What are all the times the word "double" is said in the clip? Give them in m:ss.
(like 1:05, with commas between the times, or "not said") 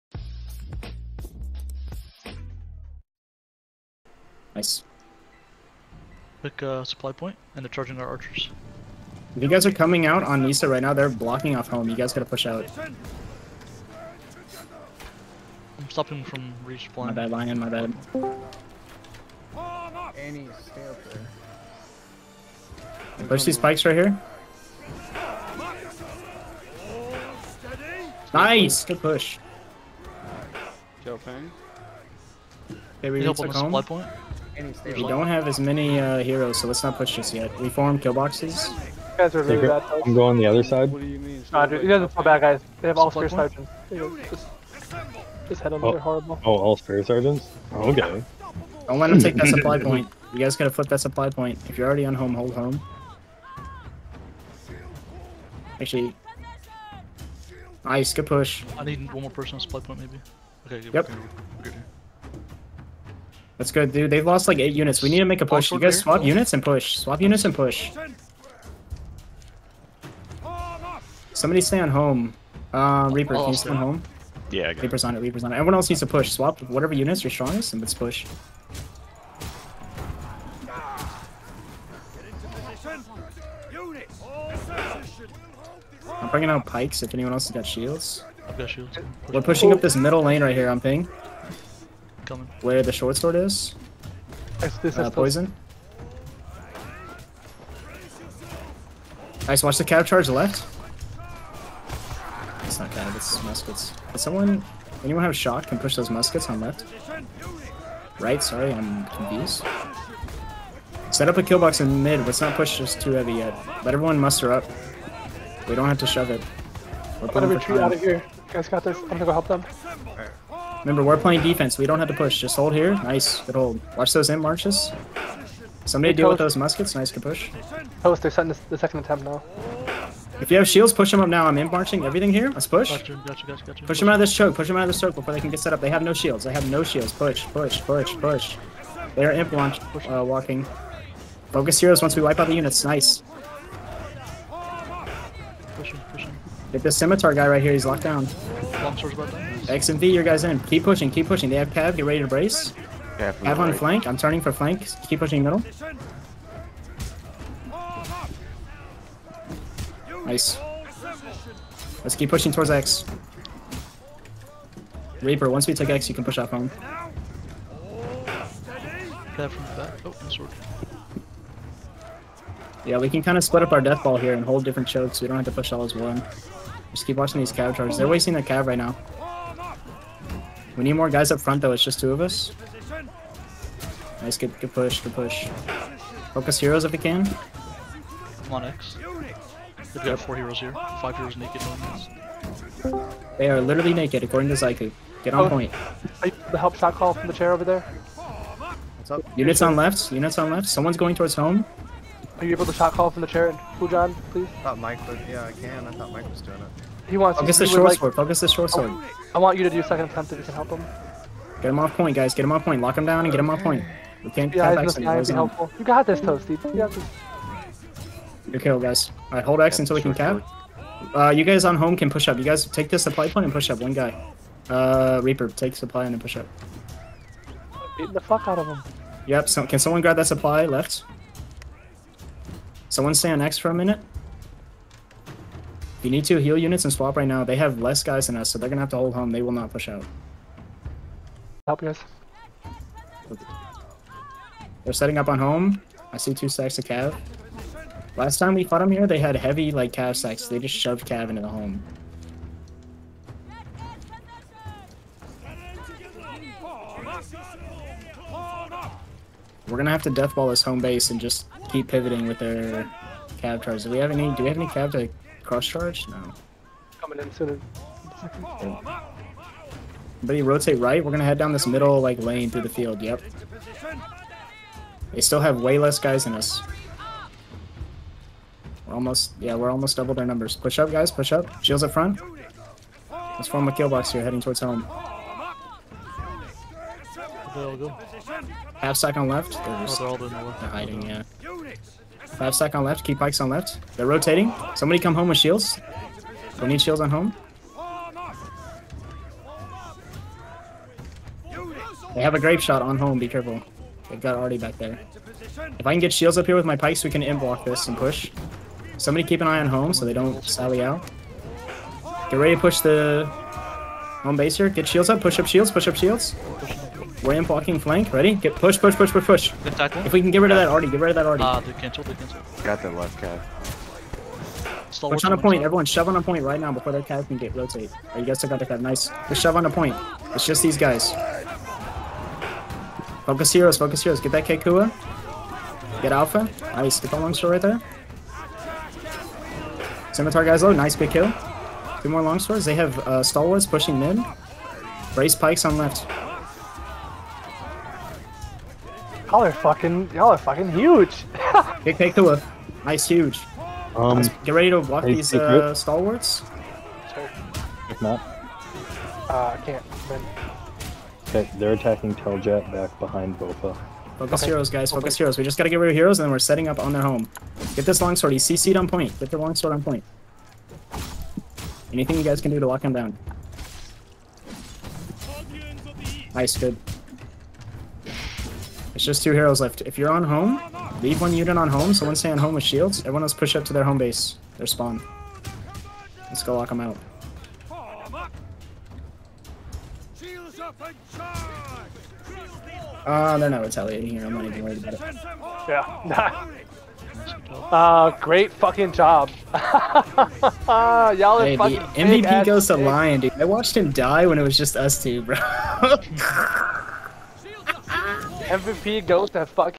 4:39.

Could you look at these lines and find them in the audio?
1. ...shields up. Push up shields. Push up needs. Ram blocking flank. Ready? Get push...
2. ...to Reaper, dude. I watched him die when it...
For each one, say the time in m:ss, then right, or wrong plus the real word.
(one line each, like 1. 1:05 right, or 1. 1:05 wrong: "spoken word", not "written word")
1. 5:14 wrong: "shields", not "needs"
2. 6:42 wrong: "Lion", not "Reaper".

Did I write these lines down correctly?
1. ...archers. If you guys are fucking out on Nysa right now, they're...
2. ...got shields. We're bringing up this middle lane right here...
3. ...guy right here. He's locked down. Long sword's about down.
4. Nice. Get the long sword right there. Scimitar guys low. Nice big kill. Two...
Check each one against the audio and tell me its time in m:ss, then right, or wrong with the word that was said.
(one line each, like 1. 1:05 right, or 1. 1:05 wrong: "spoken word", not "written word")
1. 0:08 wrong: "coming", not "fucking"
2. 1:28 wrong: "pushing", not "bringing"
3. 2:27 right
4. 5:36 right.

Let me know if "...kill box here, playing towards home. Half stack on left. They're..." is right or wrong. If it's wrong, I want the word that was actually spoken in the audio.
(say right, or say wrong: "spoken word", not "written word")
wrong: "heading", not "playing".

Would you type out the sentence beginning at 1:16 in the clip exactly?
Swap whatever units you're strongest and let's push.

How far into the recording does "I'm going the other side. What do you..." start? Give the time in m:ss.
0:40.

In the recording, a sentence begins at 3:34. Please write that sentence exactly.
We can't yeah, tap X and helpful.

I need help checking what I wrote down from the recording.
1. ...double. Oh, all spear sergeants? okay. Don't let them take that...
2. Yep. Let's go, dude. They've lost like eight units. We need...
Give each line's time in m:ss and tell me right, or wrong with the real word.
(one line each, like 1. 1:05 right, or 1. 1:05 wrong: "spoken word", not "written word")
1. 0:45 wrong: "horrible", not "double"
2. 1:00 right.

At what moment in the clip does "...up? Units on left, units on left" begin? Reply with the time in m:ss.
3:19.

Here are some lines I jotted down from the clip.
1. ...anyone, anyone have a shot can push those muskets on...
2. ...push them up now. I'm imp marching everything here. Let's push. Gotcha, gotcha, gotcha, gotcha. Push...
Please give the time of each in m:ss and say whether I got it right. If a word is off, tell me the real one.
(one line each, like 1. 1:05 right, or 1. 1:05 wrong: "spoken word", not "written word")
1. 1:44 wrong: "someone", not "anyone"
2. 2:10 right.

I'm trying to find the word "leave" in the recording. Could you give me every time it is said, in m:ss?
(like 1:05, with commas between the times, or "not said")
6:21.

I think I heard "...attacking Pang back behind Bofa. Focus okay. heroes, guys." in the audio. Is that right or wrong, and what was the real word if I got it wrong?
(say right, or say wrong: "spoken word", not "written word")
wrong: "Teljet", not "Pang".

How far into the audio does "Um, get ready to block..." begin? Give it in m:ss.
5:53.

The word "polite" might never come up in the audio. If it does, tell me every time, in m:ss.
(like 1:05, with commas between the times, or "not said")
not said.